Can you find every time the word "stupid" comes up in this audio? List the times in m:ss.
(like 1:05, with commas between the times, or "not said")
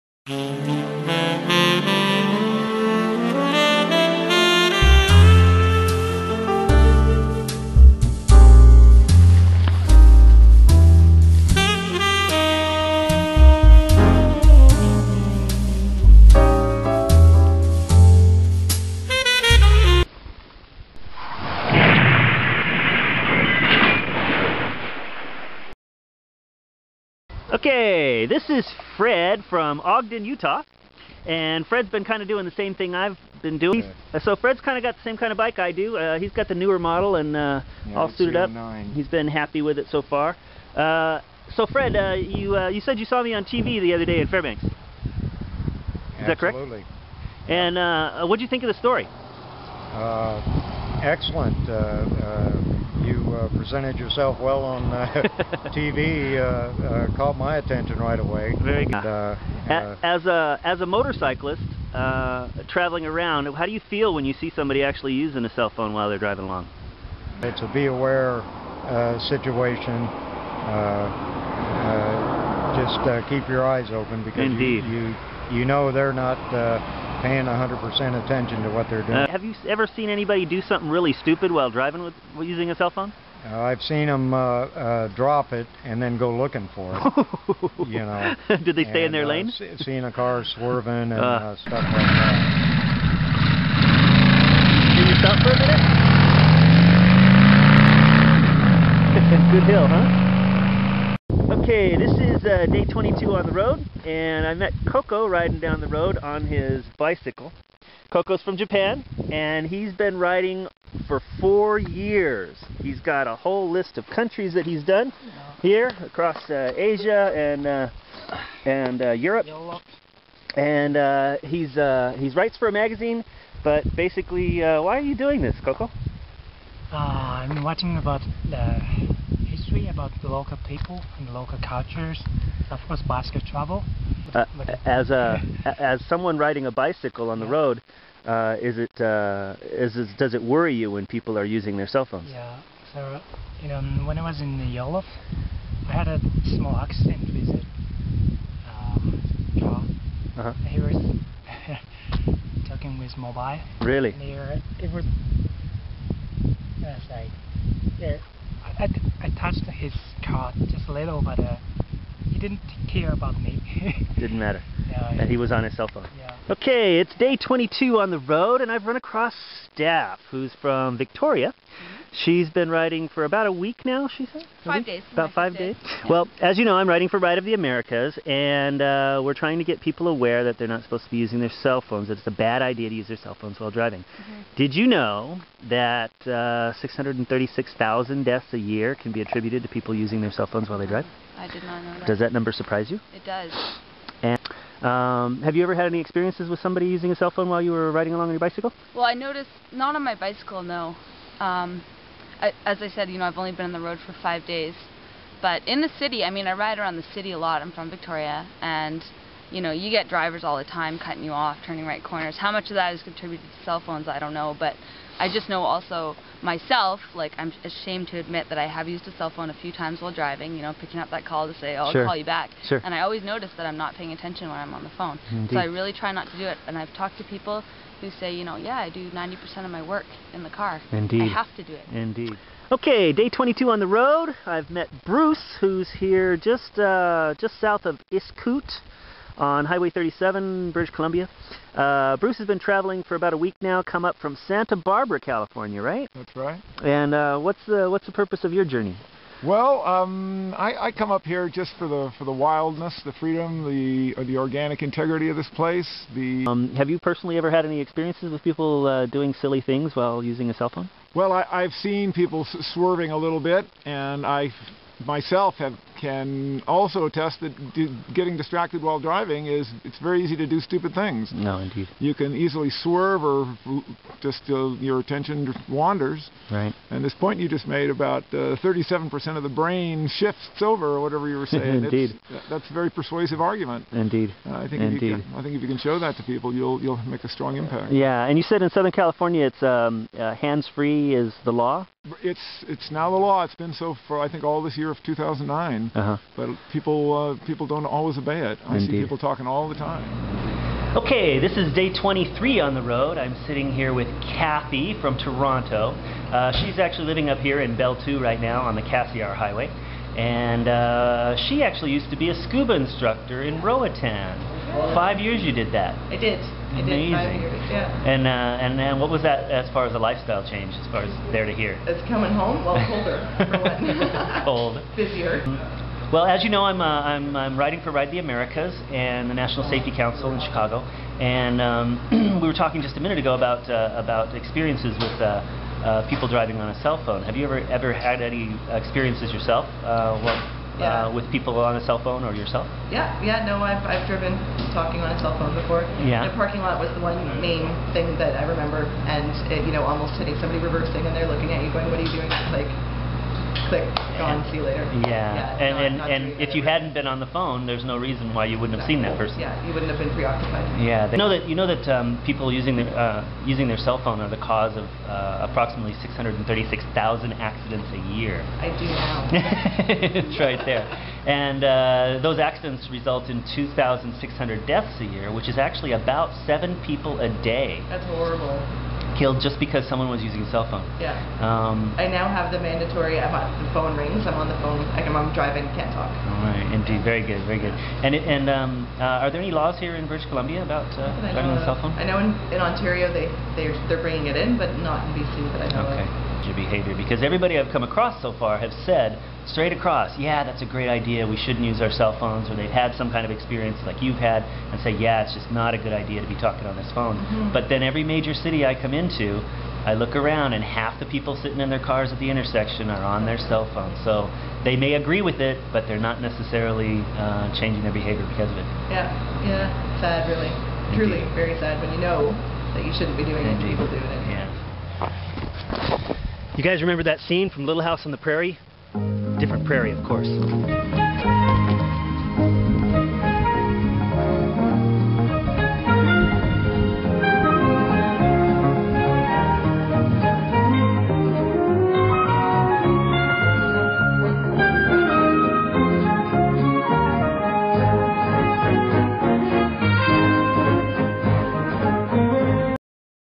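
1:21, 4:30.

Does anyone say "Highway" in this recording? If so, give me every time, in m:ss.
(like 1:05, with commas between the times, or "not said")
3:59, 5:09.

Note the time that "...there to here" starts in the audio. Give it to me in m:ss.
5:21.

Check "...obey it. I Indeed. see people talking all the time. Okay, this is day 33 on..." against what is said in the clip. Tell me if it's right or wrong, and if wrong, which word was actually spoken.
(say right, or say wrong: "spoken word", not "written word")
wrong: "23", not "33".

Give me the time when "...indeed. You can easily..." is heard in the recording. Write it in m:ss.
4:31.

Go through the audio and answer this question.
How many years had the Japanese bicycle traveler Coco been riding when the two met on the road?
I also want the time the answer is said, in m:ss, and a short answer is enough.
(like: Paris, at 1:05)
4, at 1:51.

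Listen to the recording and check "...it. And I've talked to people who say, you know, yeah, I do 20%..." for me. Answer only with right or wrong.
wrong.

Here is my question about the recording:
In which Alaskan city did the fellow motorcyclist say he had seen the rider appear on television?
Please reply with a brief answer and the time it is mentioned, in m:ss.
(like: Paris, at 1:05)
Fairbanks, at 0:44.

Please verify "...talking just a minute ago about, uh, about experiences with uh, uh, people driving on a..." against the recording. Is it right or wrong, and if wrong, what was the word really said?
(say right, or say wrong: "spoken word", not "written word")
right.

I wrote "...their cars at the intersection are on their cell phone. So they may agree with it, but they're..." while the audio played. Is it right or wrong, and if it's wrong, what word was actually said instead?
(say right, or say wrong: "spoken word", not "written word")
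right.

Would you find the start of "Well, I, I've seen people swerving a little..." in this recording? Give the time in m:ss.
4:21.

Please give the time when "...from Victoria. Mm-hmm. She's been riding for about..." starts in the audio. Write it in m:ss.
2:50.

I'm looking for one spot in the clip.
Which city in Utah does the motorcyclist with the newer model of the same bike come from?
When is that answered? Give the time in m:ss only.
0:29.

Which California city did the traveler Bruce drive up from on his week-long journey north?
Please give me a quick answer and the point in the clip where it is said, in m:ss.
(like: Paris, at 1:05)
Santa Barbara, at 4:04.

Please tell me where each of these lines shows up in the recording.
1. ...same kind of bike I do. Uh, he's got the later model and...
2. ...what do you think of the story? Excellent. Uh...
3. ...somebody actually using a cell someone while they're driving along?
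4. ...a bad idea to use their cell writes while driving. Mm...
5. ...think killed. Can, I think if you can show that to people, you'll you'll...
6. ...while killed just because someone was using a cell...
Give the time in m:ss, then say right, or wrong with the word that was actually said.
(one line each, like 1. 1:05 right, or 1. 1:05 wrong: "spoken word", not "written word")
1. 0:35 wrong: "newer", not "later"
2. 0:48 right
3. 1:04 wrong: "phone", not "someone"
4. 3:02 wrong: "phones", not "writes"
5. 4:44 wrong: "indeed", not "killed"
6. 6:18 wrong: "horrible", not "while".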